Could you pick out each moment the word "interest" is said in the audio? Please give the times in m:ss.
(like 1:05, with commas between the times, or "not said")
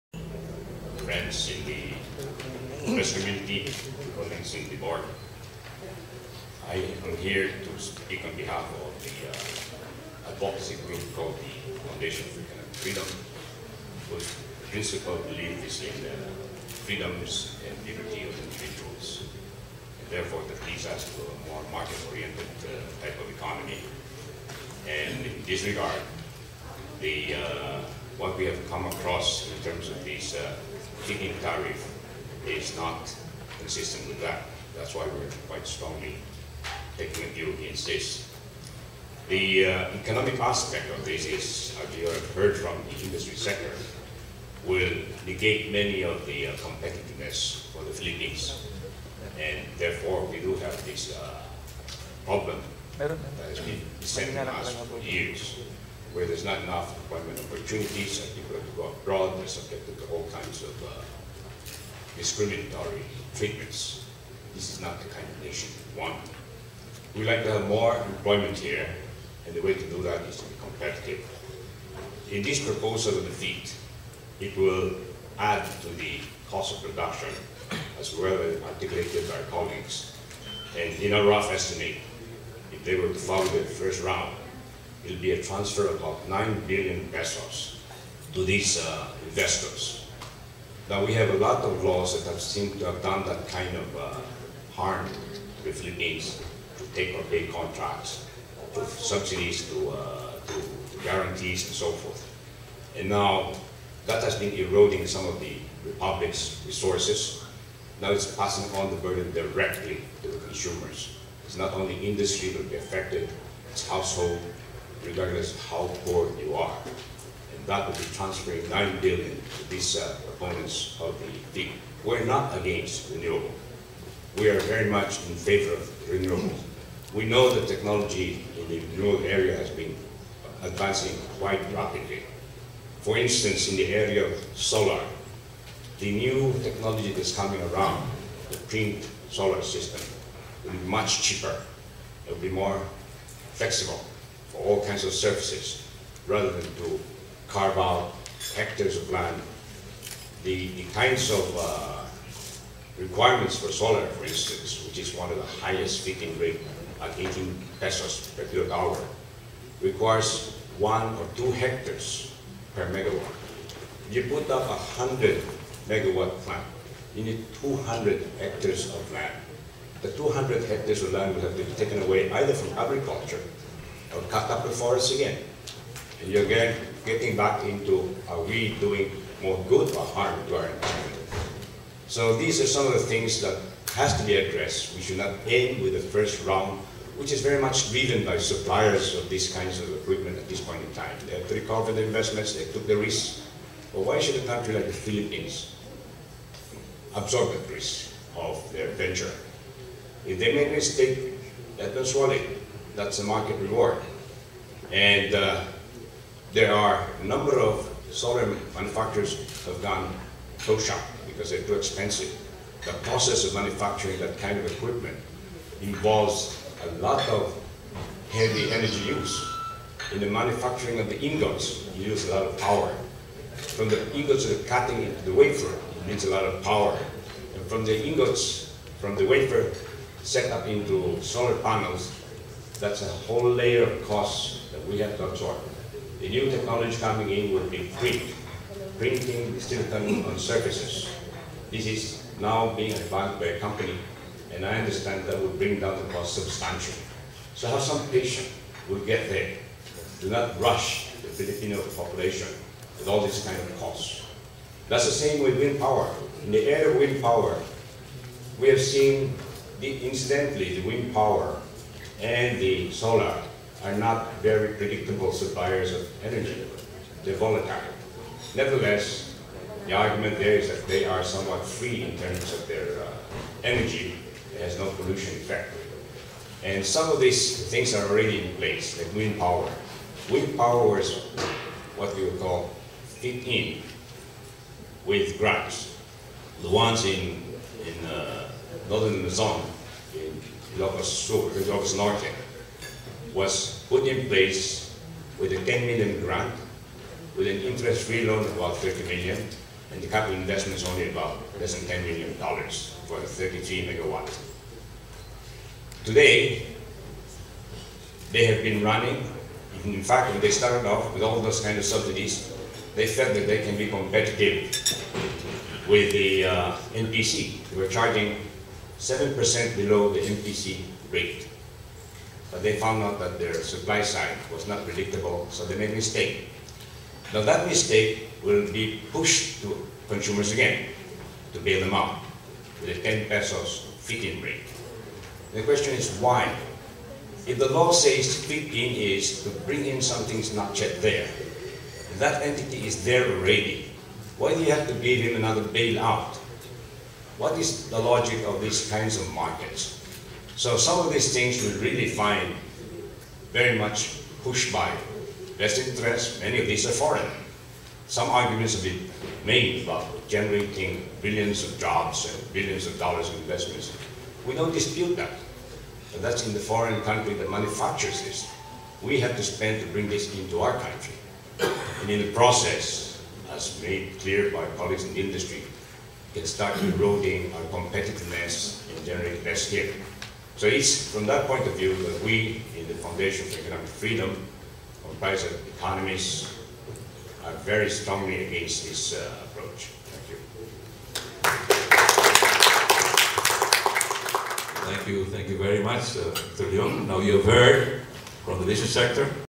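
4:57, 5:55.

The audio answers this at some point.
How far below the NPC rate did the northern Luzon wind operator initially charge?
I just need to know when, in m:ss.
5:19.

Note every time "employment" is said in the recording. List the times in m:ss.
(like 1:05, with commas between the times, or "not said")
0:57, 1:07.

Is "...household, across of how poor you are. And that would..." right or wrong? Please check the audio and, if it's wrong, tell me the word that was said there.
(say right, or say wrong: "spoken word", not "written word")
wrong: "regardless", not "across".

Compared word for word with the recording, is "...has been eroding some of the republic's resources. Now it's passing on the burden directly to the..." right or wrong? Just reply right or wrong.
right.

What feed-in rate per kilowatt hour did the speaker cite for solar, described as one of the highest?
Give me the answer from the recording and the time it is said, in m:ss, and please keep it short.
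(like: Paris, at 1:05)
18 pesos, at 2:37.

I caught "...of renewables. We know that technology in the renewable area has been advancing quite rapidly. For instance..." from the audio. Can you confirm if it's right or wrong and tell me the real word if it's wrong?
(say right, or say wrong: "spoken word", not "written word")
right.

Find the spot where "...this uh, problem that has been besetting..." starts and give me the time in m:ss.
0:50.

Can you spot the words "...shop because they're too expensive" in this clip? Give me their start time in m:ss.
3:30.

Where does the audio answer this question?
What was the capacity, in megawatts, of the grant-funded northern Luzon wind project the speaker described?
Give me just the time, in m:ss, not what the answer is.
5:03.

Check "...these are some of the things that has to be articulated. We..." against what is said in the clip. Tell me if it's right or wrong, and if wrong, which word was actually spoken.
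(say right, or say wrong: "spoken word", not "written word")
wrong: "addressed", not "articulated".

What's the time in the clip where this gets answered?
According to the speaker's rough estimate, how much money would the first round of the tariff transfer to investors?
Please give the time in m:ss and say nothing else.
1:26.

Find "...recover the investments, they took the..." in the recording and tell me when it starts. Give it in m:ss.
3:11.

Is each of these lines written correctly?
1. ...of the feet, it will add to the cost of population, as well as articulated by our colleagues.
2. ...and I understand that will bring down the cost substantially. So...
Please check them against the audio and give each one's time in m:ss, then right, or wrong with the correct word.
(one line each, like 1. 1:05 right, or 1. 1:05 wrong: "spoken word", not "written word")
1. 1:13 wrong: "production", not "population"
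2. 4:04 right.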